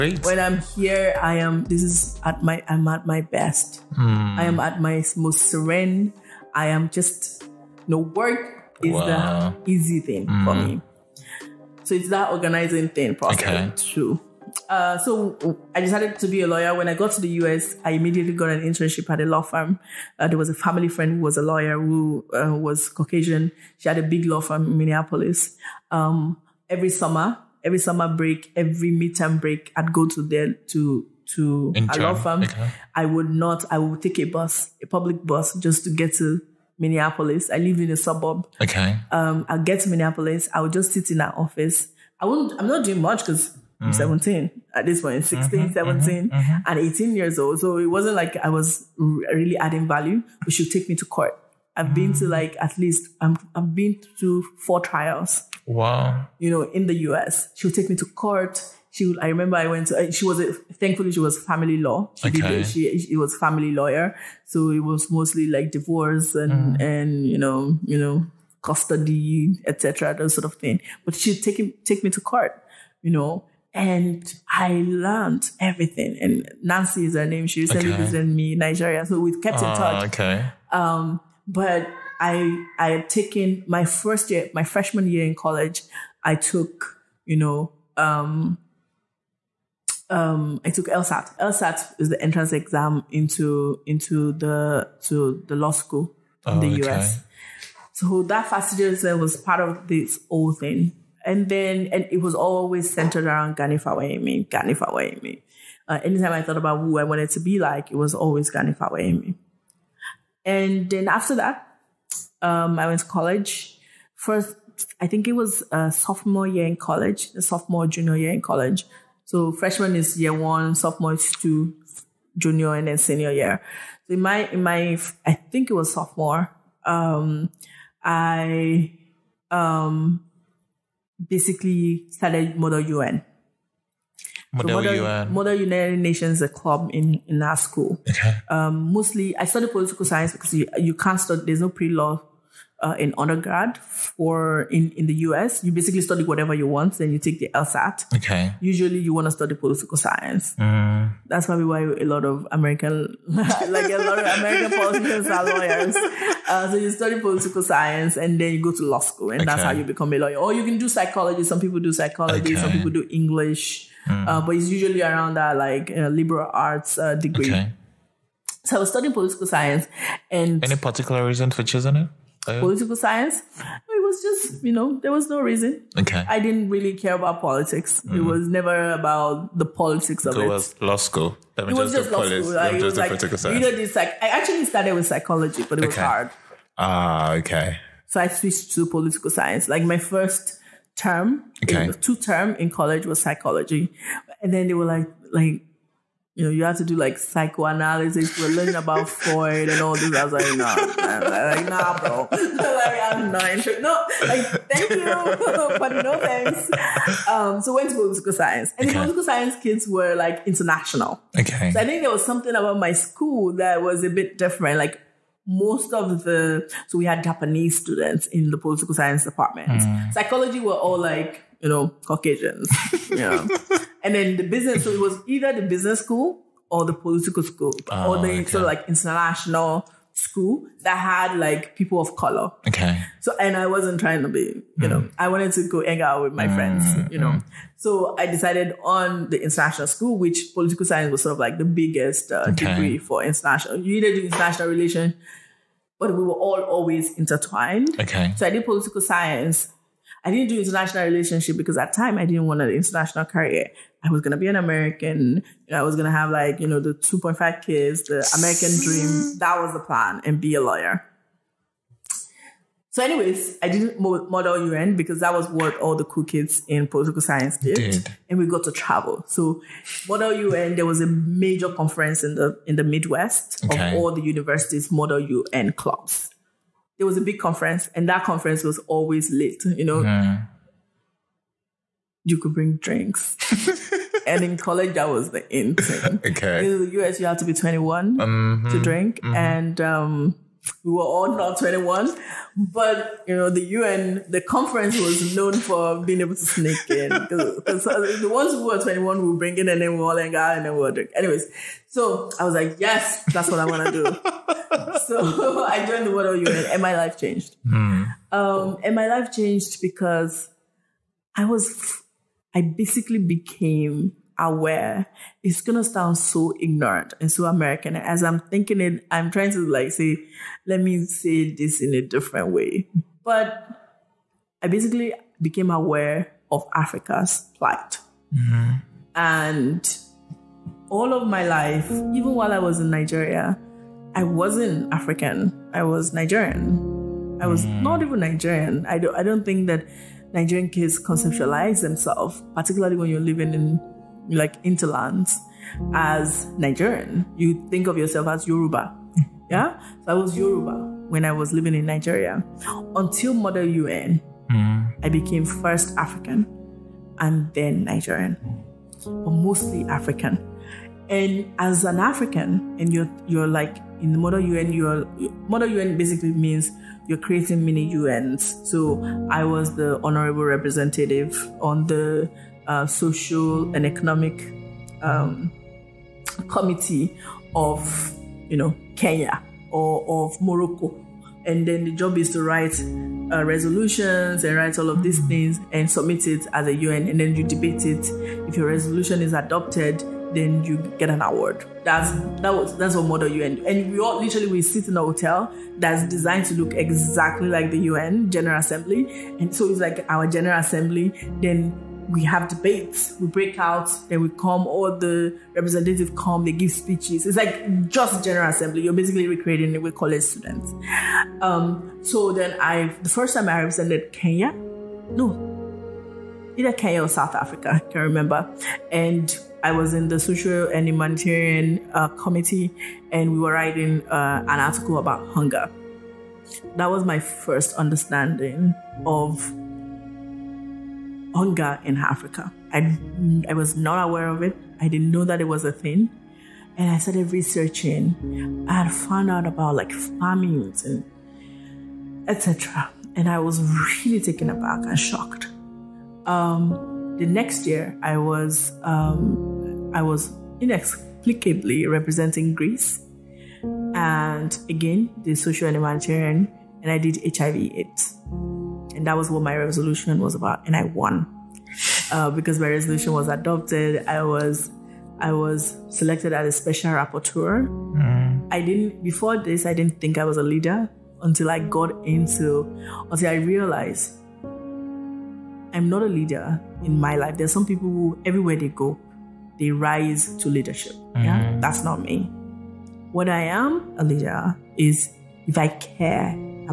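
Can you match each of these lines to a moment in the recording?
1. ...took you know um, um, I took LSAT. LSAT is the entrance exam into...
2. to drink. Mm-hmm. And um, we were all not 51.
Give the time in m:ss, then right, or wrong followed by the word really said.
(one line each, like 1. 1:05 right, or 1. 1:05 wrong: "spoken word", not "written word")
1. 1:26 right
2. 4:48 wrong: "21", not "51".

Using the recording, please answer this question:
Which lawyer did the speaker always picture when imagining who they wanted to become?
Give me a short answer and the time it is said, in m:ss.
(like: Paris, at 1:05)
Gani Fawehinmi, at 1:43.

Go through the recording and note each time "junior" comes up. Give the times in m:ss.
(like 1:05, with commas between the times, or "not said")
1:57, 2:02.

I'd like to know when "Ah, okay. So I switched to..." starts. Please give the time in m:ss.
3:06.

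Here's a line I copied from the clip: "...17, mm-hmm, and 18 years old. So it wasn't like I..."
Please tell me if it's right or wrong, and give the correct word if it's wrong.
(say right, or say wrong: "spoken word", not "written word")
right.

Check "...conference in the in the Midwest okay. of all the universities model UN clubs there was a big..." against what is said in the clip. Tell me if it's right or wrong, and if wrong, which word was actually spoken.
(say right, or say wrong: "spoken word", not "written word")
right.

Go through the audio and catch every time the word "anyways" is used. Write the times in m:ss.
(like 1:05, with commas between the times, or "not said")
4:23, 5:01.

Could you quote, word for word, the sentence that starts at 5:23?
But I basically became aware of Africa's plight.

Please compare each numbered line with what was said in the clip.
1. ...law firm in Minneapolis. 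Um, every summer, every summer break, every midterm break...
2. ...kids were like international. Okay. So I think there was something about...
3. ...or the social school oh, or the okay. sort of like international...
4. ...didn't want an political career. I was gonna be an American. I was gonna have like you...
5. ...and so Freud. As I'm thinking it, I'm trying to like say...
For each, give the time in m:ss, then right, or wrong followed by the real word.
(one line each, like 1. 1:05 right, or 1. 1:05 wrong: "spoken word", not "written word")
1. 0:24 right
2. 3:29 right
3. 3:46 wrong: "political", not "social"
4. 4:12 wrong: "international", not "political"
5. 5:17 wrong: "American", not "Freud".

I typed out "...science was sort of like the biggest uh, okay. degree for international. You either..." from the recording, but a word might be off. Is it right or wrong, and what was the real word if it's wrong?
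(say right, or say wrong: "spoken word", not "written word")
right.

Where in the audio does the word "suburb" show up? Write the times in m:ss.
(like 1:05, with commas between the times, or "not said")
0:37.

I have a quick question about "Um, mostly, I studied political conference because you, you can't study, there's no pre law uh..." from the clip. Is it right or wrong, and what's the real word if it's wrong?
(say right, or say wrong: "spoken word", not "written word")
wrong: "science", not "conference".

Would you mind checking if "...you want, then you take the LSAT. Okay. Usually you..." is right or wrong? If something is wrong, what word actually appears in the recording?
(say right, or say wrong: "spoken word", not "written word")
right.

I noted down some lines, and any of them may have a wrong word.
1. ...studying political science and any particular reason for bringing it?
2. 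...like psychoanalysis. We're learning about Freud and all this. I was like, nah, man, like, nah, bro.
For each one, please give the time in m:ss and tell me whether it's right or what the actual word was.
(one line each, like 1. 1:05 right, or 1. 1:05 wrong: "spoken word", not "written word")
1. 2:48 wrong: "choosing", not "bringing"
2. 3:16 right.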